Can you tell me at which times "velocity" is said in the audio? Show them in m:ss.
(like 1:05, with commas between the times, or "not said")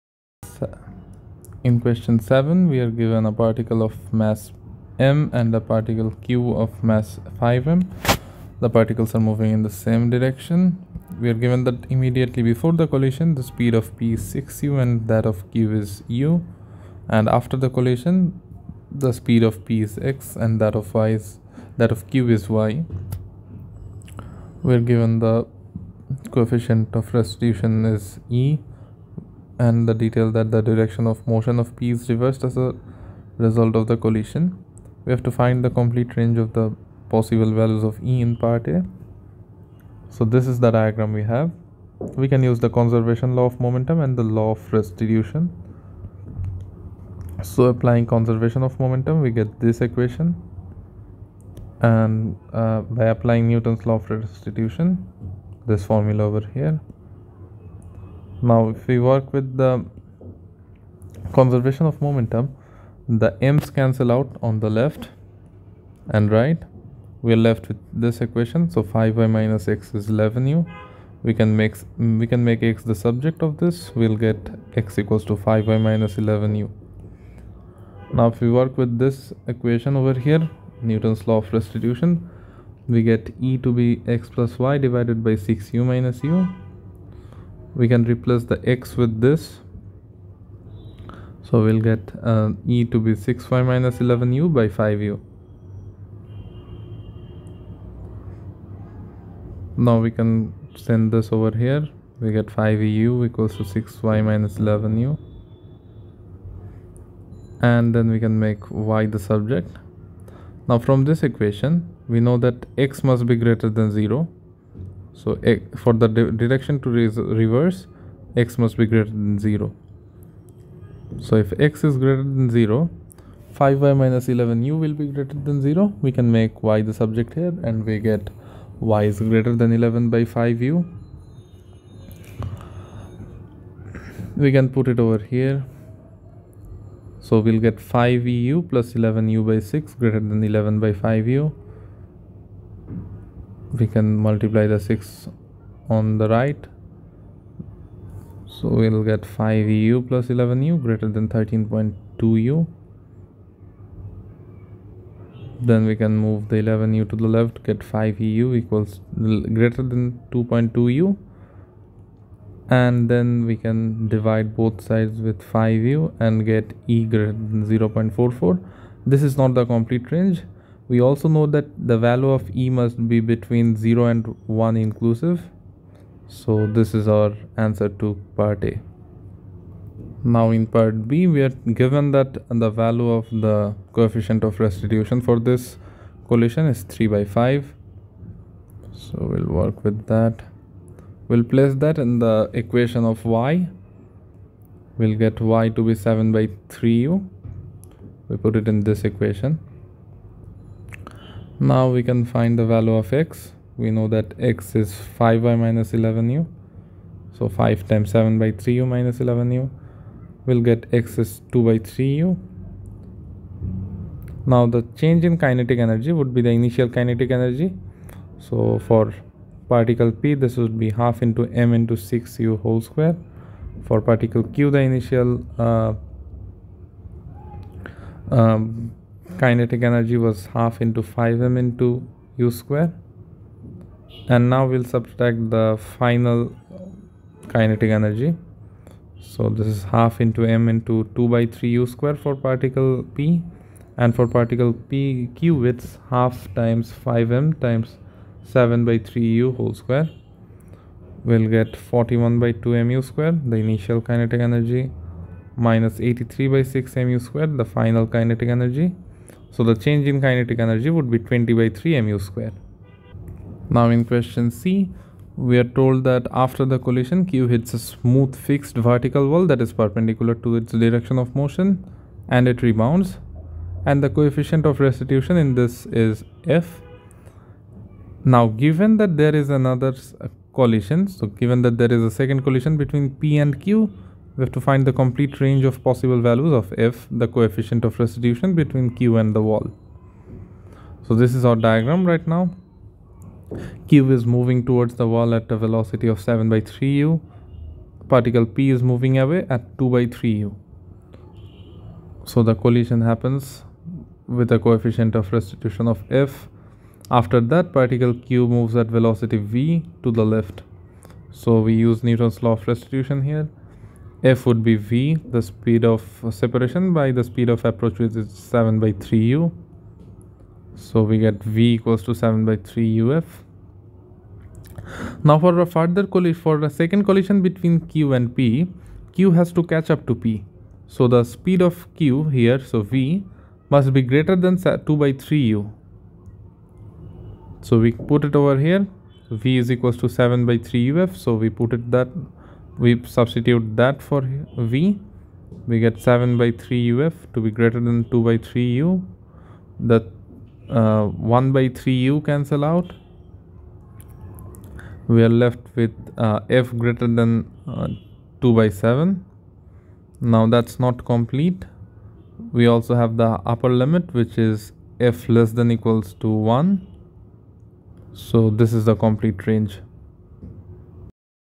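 4:55, 5:08.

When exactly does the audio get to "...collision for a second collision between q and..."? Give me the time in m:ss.
5:26.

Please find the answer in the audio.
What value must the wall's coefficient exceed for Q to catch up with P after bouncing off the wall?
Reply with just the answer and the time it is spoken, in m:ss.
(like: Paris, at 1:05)
2/7, at 5:58.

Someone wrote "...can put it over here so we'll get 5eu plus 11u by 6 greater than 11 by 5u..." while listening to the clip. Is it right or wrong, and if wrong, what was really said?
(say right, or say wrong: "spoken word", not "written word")
right.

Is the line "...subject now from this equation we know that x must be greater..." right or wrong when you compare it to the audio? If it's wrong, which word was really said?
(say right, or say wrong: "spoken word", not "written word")
right.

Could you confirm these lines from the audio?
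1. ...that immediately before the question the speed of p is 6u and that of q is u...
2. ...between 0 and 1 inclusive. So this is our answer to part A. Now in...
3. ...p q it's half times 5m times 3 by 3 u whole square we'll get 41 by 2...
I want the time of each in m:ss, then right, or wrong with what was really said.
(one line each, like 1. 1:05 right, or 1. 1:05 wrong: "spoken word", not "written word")
1. 0:11 wrong: "collision", not "question"
2. 2:53 right
3. 4:04 wrong: "7", not "3".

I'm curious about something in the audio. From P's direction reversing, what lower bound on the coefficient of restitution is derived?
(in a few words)
0.44.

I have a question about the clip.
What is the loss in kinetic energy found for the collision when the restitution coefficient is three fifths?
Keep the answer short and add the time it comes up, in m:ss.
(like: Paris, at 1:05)
20/3 mu², at 4:21.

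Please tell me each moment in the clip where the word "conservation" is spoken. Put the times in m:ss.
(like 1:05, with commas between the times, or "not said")
0:42, 0:48, 1:01.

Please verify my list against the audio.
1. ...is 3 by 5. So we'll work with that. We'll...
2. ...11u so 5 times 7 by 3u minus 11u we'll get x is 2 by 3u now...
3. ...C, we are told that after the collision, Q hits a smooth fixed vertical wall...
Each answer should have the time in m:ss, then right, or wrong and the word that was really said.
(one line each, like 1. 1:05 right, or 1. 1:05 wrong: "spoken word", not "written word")
1. 3:06 right
2. 3:25 right
3. 4:24 right.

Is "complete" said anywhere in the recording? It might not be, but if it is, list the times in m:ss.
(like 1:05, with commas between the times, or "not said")
0:35, 2:49, 4:44, 6:01, 6:09.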